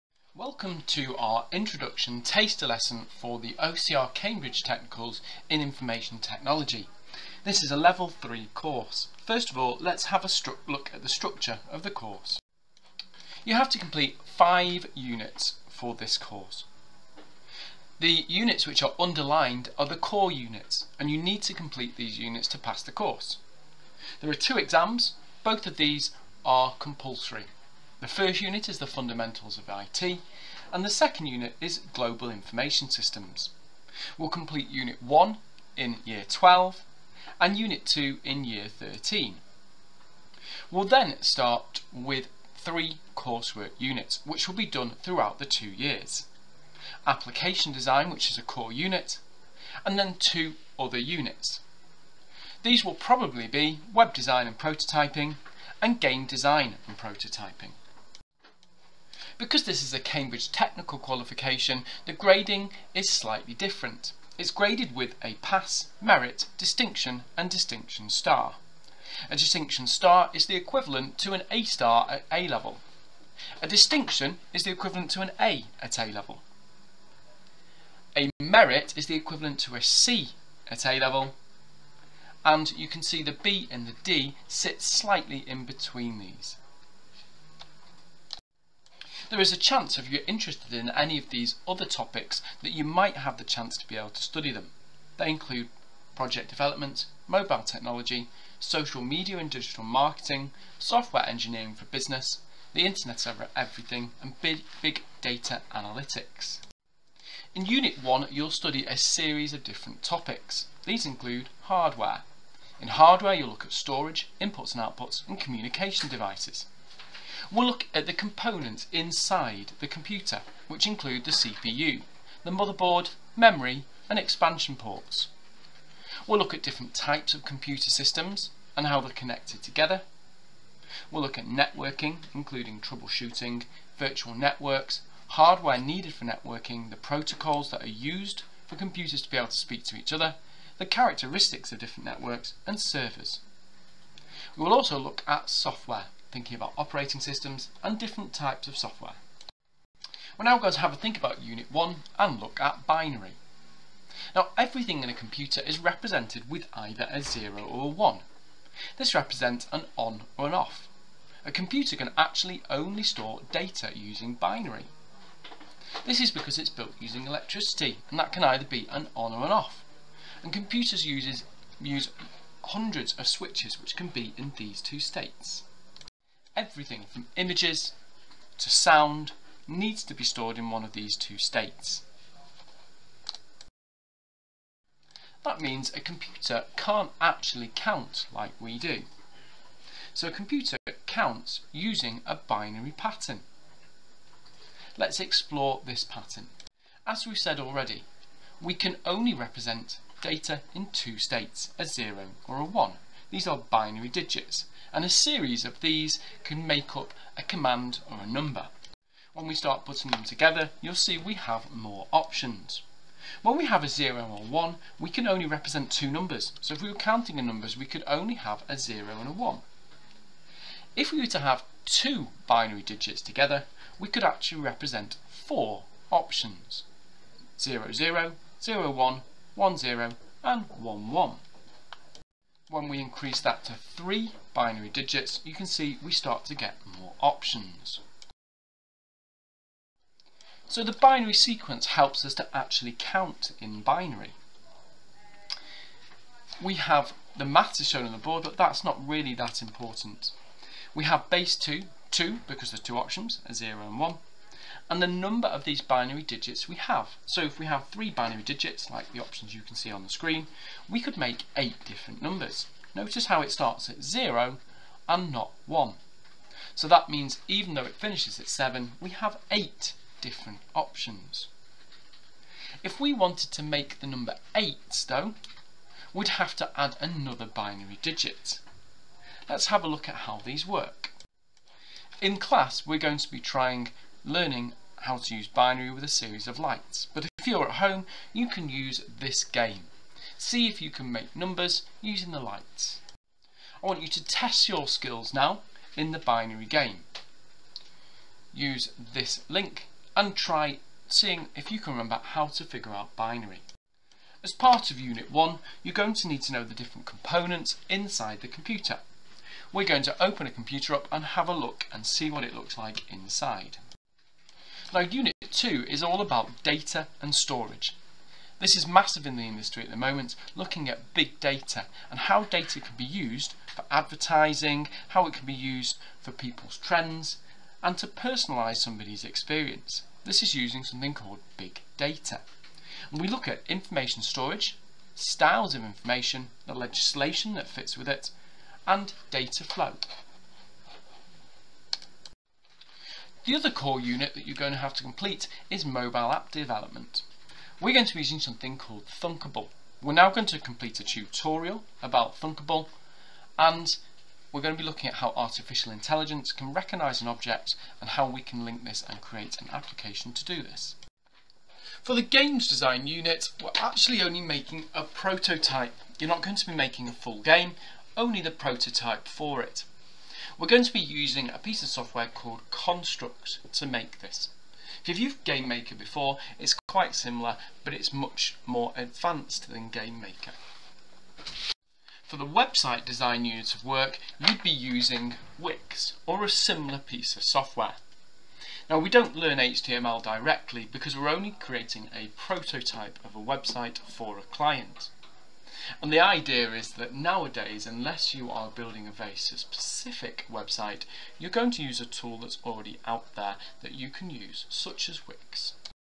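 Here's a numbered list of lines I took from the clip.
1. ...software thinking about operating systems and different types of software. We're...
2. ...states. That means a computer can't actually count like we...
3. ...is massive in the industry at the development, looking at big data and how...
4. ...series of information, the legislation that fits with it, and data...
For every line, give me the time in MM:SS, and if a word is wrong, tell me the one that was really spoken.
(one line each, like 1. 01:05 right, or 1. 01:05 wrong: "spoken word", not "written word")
1. 02:25 right
2. 03:01 right
3. 05:18 wrong: "moment", not "development"
4. 05:35 wrong: "styles", not "series".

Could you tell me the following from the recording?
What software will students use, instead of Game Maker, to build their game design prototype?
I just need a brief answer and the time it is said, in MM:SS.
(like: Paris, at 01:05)
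Constructs, at 06:12.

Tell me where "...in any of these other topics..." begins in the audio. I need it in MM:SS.
01:30.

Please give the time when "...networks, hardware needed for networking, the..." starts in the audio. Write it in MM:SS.
02:14.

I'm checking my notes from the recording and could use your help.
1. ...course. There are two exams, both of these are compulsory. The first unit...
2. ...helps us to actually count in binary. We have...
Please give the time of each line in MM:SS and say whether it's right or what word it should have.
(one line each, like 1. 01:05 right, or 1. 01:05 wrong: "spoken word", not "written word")
1. 00:22 right
2. 04:01 right.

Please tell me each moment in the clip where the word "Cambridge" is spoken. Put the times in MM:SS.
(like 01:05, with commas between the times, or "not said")
00:04, 00:59.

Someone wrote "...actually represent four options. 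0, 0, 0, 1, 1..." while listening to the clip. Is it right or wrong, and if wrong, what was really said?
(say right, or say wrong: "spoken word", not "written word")
right.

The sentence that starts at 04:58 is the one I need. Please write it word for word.
Use this link and try seeing if you can remember how to figure out binary.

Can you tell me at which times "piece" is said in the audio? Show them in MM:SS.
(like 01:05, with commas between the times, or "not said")
06:11, 06:26.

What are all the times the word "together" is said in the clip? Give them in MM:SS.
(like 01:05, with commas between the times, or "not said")
02:09, 03:30, 03:43.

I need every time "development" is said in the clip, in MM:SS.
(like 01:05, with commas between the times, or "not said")
01:36, 05:46.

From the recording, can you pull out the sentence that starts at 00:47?
Application design which is a core unit and then two other units.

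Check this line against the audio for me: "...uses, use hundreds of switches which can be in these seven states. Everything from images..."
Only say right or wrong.
wrong.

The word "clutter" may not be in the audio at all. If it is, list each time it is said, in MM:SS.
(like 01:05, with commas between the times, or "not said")
not said.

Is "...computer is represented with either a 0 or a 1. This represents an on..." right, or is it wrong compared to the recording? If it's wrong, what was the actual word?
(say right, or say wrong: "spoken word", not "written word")
right.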